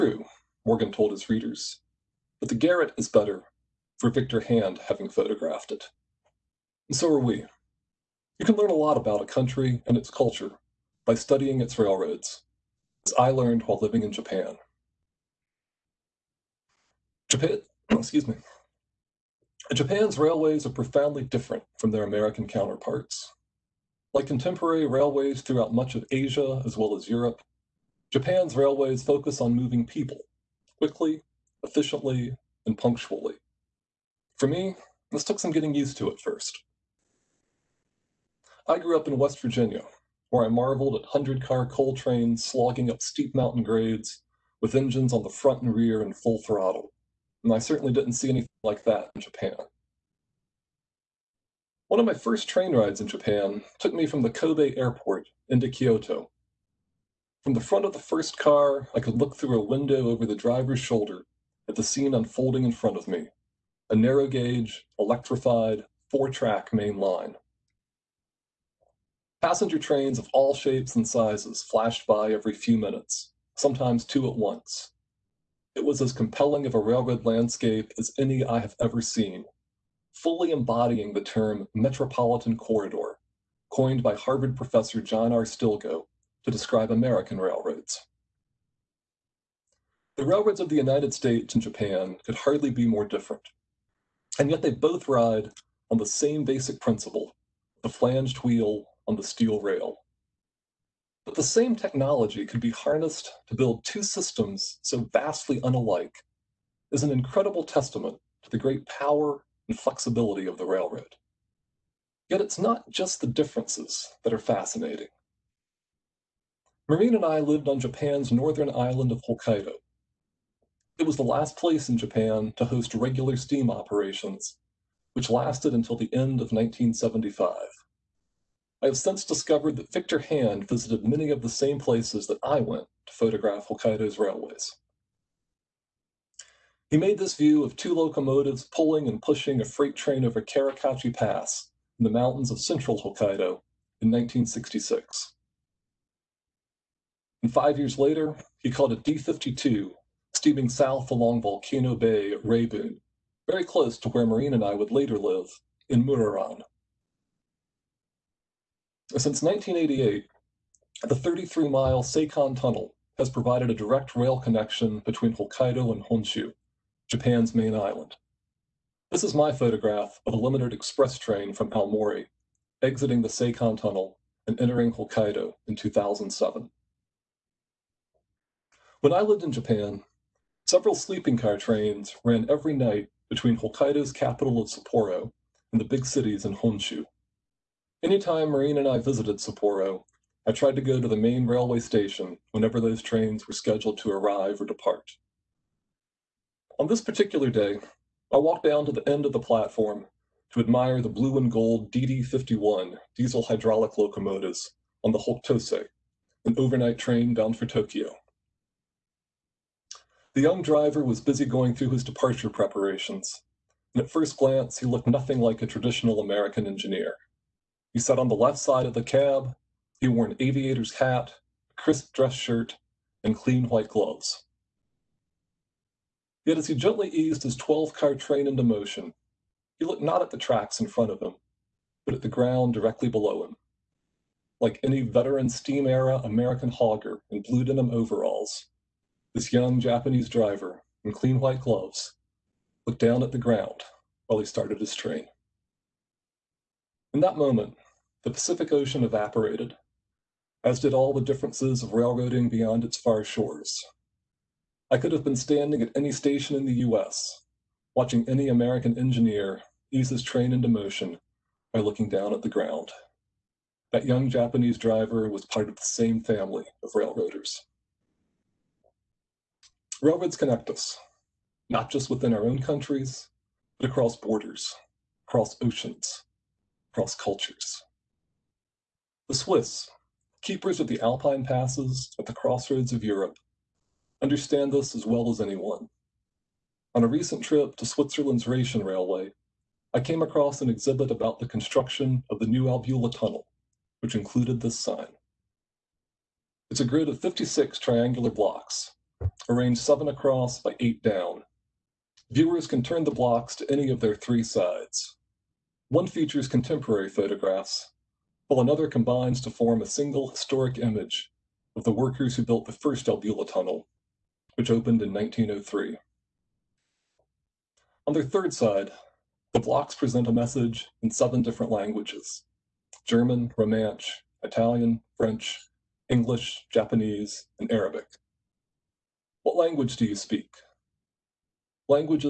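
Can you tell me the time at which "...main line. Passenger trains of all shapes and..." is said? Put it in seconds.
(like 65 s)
66 s.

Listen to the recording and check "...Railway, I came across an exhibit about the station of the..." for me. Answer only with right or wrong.
wrong.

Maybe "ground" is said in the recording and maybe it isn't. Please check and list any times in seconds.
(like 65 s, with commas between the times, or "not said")
232 s, 243 s, 262 s.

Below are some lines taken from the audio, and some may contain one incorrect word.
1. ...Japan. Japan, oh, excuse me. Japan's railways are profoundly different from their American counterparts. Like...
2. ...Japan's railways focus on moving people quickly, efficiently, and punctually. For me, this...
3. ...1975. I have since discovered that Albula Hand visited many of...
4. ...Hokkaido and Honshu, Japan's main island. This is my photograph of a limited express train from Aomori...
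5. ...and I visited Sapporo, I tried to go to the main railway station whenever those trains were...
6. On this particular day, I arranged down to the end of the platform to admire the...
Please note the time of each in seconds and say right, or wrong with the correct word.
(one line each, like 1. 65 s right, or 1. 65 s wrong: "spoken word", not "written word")
1. 14 s right
2. 28 s right
3. 126 s wrong: "Victor", not "Albula"
4. 165 s right
5. 188 s right
6. 196 s wrong: "walked", not "arranged".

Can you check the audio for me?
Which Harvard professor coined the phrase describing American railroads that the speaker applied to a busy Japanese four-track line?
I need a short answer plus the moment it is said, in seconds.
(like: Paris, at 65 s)
John R. Stilgoe, at 85 s.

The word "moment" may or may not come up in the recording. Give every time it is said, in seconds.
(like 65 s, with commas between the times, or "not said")
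247 s.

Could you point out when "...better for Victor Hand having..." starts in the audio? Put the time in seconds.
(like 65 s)
3 s.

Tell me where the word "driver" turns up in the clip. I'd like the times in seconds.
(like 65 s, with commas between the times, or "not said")
60 s, 210 s, 240 s, 264 s.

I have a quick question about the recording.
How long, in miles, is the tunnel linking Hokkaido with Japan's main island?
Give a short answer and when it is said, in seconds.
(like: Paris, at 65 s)
33 miles, at 161 s.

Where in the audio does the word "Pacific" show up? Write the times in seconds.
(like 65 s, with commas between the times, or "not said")
248 s.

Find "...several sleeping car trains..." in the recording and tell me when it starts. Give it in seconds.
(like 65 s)
180 s.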